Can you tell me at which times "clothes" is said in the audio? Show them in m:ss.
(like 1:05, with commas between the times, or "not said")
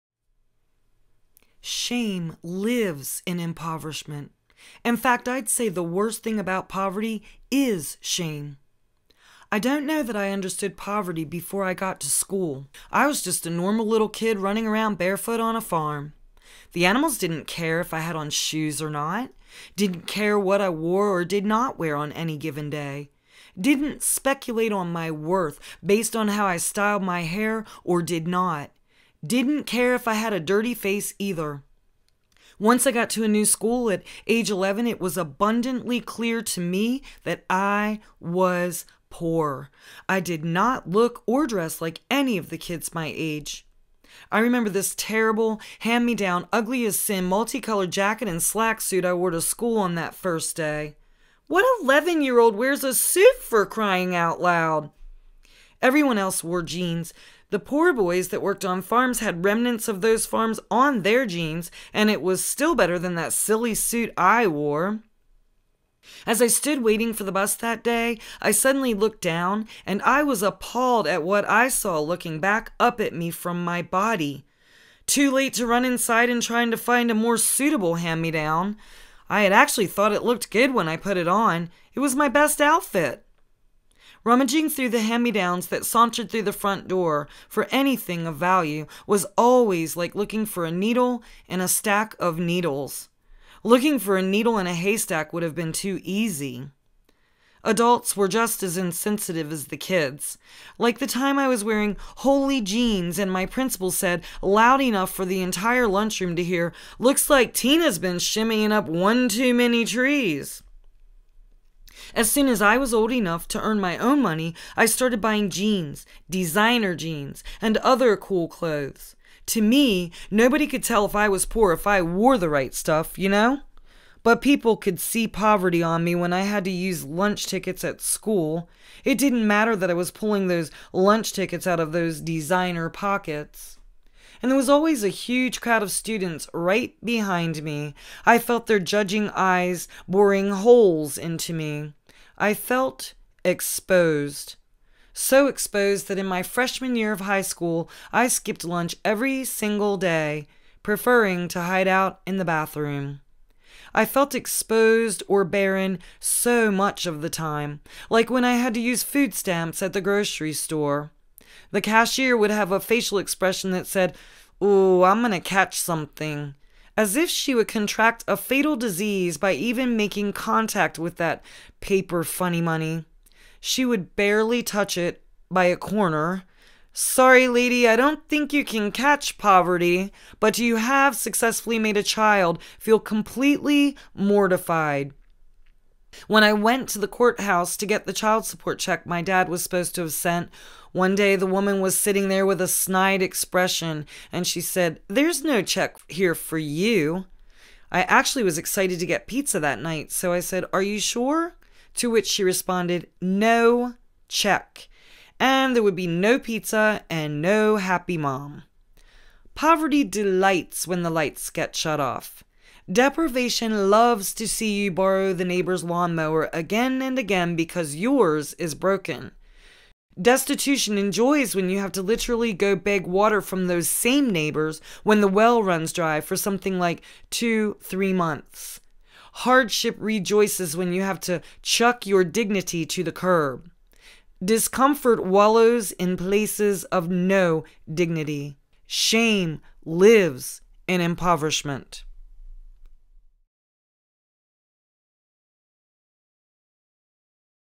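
1:58.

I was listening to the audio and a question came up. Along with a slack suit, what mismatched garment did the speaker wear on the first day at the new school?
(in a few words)
multicolored jacket.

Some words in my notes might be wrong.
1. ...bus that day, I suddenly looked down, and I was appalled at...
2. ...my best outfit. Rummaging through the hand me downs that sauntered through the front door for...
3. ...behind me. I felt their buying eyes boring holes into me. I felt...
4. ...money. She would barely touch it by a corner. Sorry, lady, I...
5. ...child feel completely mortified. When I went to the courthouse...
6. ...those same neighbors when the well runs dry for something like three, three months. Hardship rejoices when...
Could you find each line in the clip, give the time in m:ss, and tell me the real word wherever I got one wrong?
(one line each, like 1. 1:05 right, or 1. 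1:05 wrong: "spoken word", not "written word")
1. 1:07 right
2. 1:22 right
3. 2:17 wrong: "judging", not "buying"
4. 2:52 right
5. 3:02 right
6. 3:43 wrong: "two", not "three".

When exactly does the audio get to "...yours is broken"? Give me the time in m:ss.
3:37.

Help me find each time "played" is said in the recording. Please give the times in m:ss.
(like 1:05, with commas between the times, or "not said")
not said.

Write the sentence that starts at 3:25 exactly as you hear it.
And there would be no pizza and no happy mom.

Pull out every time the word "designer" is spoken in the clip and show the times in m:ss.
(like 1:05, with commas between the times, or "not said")
1:56, 2:12.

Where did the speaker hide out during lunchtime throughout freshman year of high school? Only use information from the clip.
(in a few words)
the bathroom.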